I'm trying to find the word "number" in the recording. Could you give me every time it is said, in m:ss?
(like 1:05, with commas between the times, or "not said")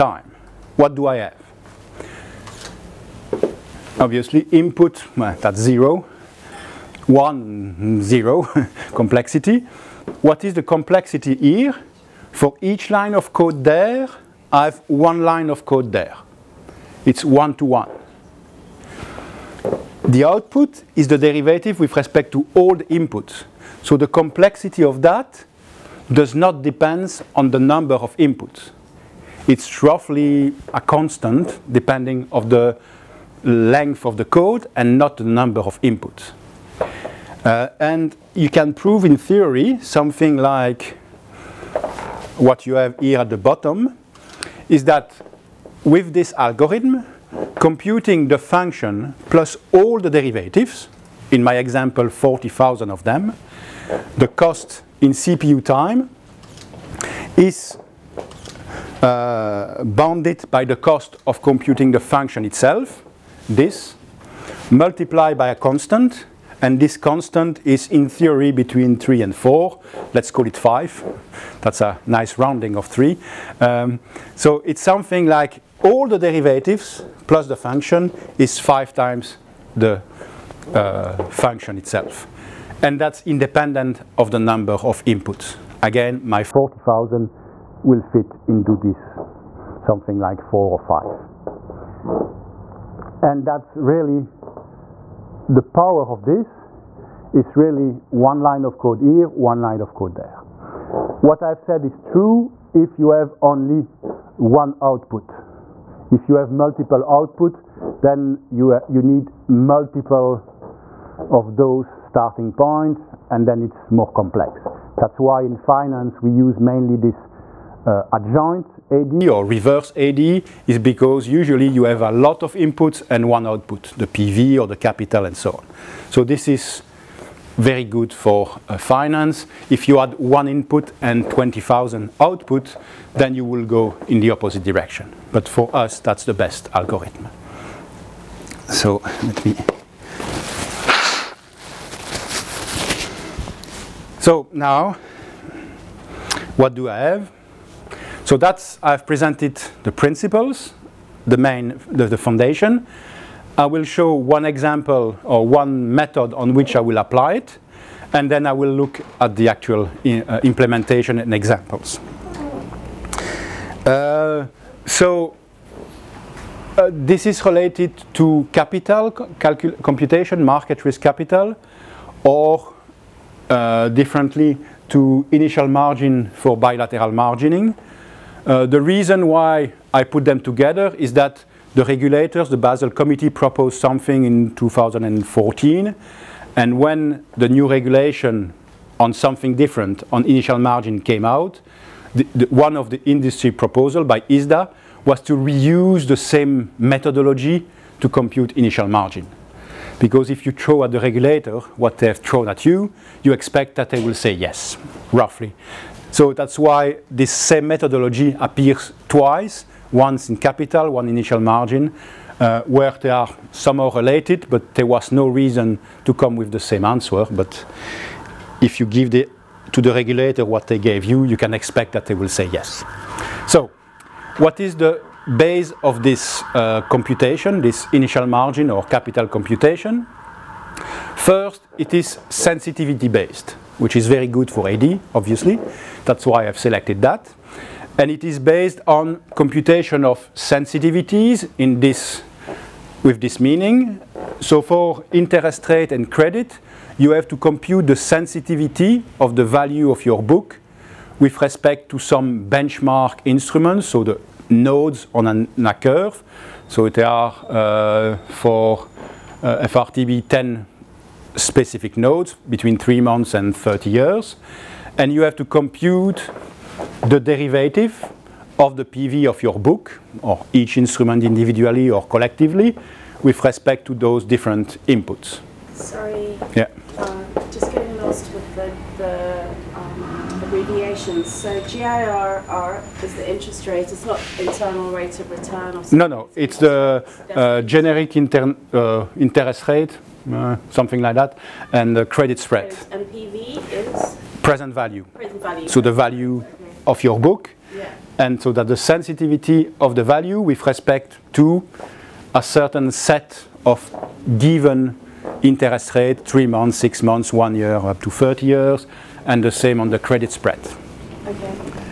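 0:27, 0:35, 1:24.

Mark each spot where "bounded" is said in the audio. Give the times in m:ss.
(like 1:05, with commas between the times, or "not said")
0:59.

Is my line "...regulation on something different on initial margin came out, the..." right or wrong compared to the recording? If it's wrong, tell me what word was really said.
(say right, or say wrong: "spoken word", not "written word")
right.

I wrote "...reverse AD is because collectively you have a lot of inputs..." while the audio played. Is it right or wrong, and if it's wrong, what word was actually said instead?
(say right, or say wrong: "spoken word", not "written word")
wrong: "usually", not "collectively".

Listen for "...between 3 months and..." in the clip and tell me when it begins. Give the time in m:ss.
4:22.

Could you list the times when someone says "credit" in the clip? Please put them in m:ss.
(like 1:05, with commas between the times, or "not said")
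4:06, 4:52, 5:09.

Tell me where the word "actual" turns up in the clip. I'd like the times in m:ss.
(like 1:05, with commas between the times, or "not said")
2:39.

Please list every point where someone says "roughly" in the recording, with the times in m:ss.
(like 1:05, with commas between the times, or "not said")
0:29, 3:25.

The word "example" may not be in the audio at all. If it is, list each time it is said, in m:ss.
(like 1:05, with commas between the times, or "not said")
0:51, 2:34, 2:41.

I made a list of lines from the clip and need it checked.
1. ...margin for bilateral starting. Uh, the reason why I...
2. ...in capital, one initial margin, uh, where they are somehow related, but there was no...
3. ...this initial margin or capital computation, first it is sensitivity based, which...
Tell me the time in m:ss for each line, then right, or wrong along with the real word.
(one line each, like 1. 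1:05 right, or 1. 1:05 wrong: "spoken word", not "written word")
1. 2:55 wrong: "margining", not "starting"
2. 3:30 right
3. 3:47 right.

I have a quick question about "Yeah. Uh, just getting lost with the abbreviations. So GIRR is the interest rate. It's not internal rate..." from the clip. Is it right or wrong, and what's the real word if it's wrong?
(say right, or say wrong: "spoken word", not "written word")
right.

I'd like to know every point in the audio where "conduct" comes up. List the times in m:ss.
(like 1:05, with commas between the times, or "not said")
not said.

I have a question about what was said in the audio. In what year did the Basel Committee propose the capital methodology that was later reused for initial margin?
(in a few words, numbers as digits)
2014.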